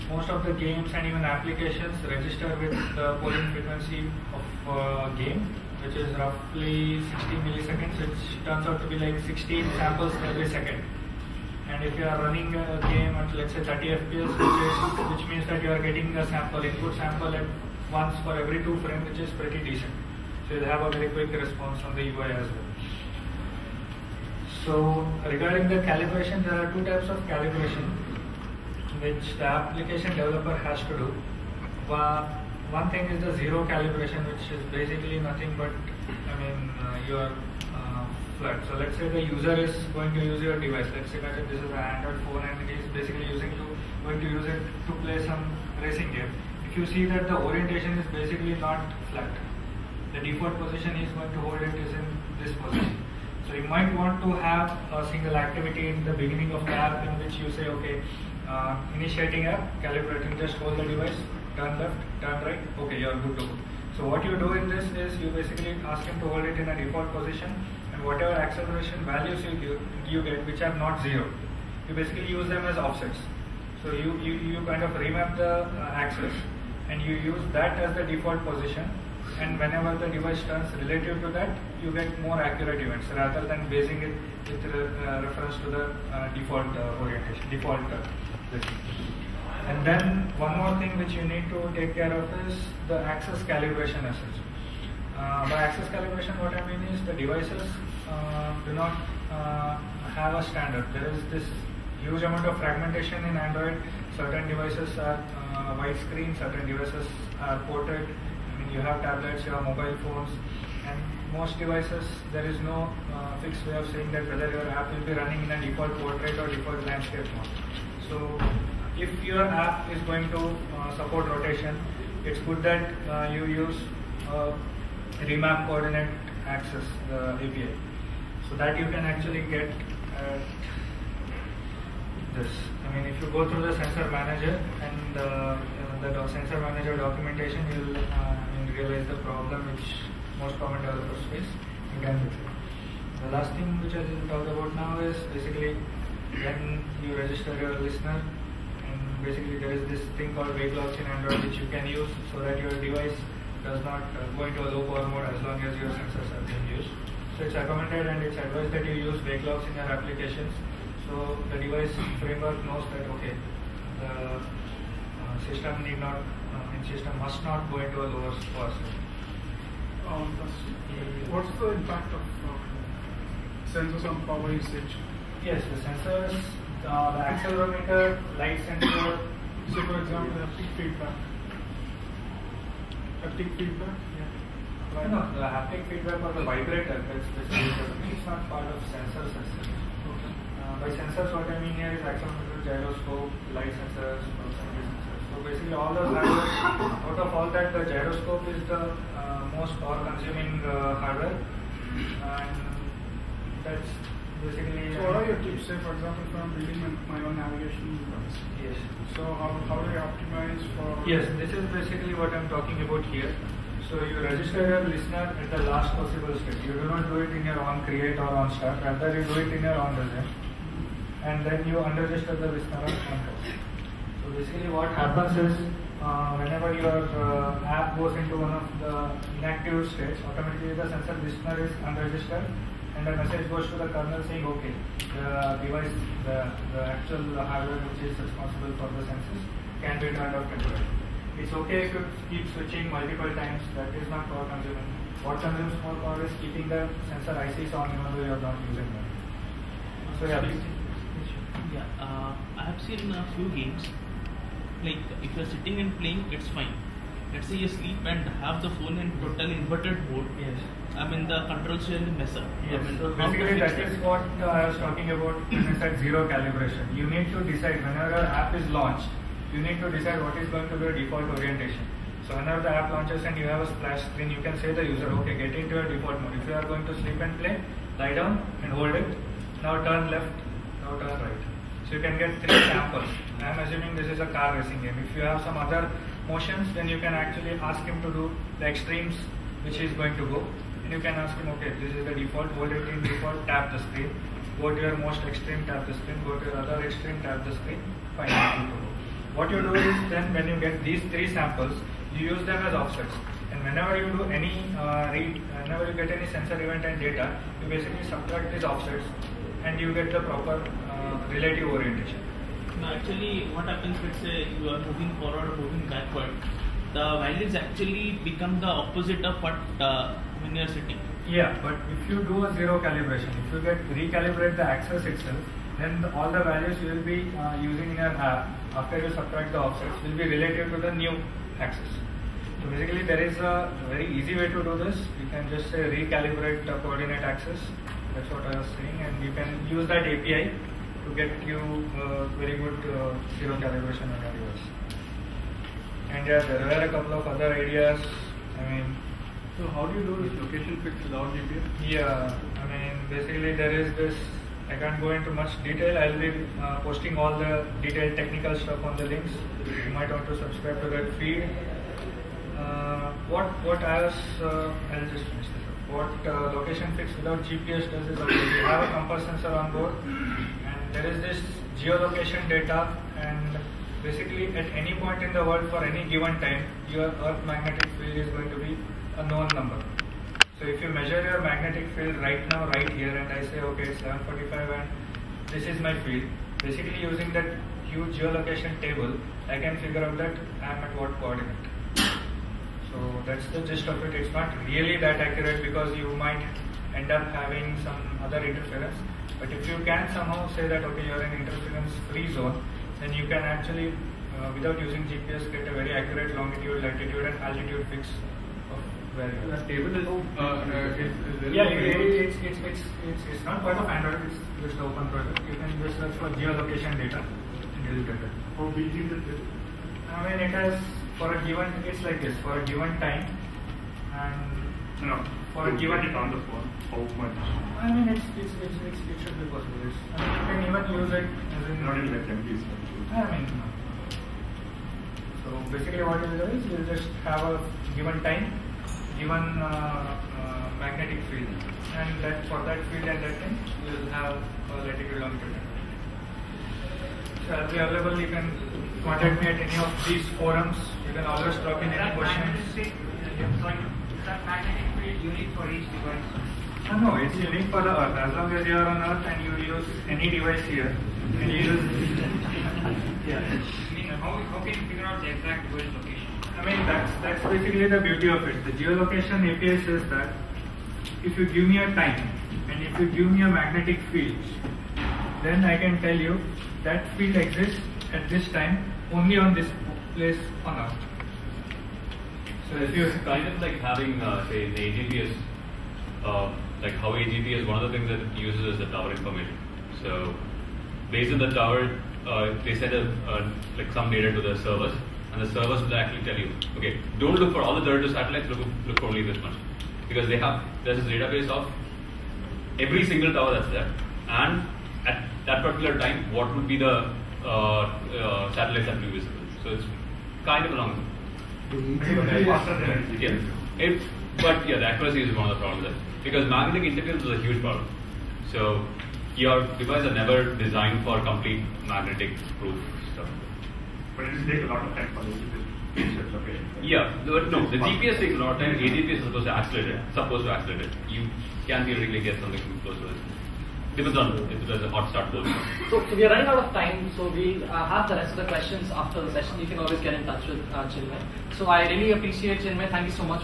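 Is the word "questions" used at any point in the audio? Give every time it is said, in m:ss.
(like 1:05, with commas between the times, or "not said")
7:32, 8:58.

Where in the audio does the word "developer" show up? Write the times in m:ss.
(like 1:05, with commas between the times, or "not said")
0:30, 2:20.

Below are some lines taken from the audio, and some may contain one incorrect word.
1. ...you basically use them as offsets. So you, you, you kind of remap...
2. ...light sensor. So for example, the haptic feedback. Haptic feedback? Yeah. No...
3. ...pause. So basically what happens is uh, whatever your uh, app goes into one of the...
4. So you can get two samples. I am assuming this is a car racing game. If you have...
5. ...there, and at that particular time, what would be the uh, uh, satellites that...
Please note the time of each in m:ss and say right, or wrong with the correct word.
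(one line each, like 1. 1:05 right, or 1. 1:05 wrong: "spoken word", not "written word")
1. 1:11 right
2. 2:58 right
3. 3:43 wrong: "whenever", not "whatever"
4. 4:41 wrong: "three", not "two"
5. 8:23 right.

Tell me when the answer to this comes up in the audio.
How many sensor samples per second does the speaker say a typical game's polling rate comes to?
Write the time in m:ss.
0:09.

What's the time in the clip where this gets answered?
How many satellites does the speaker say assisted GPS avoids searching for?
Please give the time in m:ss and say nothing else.
8:17.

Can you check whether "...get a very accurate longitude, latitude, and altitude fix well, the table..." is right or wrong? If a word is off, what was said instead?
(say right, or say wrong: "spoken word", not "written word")
right.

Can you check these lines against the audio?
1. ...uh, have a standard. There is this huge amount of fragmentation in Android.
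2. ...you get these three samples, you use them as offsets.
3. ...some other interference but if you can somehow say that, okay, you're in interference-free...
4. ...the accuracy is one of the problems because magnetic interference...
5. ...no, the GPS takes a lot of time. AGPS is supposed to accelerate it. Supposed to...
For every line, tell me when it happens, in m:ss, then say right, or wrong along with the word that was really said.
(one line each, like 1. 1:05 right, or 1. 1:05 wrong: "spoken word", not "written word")
1. 1:39 right
2. 5:00 right
3. 6:37 right
4. 8:34 right
5. 8:47 right.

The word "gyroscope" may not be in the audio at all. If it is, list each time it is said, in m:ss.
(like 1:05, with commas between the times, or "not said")
3:12, 3:17.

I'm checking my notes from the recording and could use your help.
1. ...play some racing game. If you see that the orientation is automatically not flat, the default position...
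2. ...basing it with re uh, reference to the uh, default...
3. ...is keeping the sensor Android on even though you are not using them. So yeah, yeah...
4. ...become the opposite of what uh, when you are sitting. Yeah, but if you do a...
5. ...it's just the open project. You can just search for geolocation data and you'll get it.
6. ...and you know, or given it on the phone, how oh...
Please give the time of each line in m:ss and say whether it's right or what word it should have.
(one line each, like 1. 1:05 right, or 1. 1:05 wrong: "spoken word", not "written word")
1. 0:45 wrong: "basically", not "automatically"
2. 1:23 right
3. 4:06 wrong: "ICs", not "Android"
4. 5:18 right
5. 6:54 right
6. 7:04 right.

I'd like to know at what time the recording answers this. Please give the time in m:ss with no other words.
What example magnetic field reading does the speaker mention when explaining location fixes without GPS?
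6:23.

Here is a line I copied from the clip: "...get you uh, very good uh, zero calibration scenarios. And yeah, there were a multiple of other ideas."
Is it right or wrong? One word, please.
wrong.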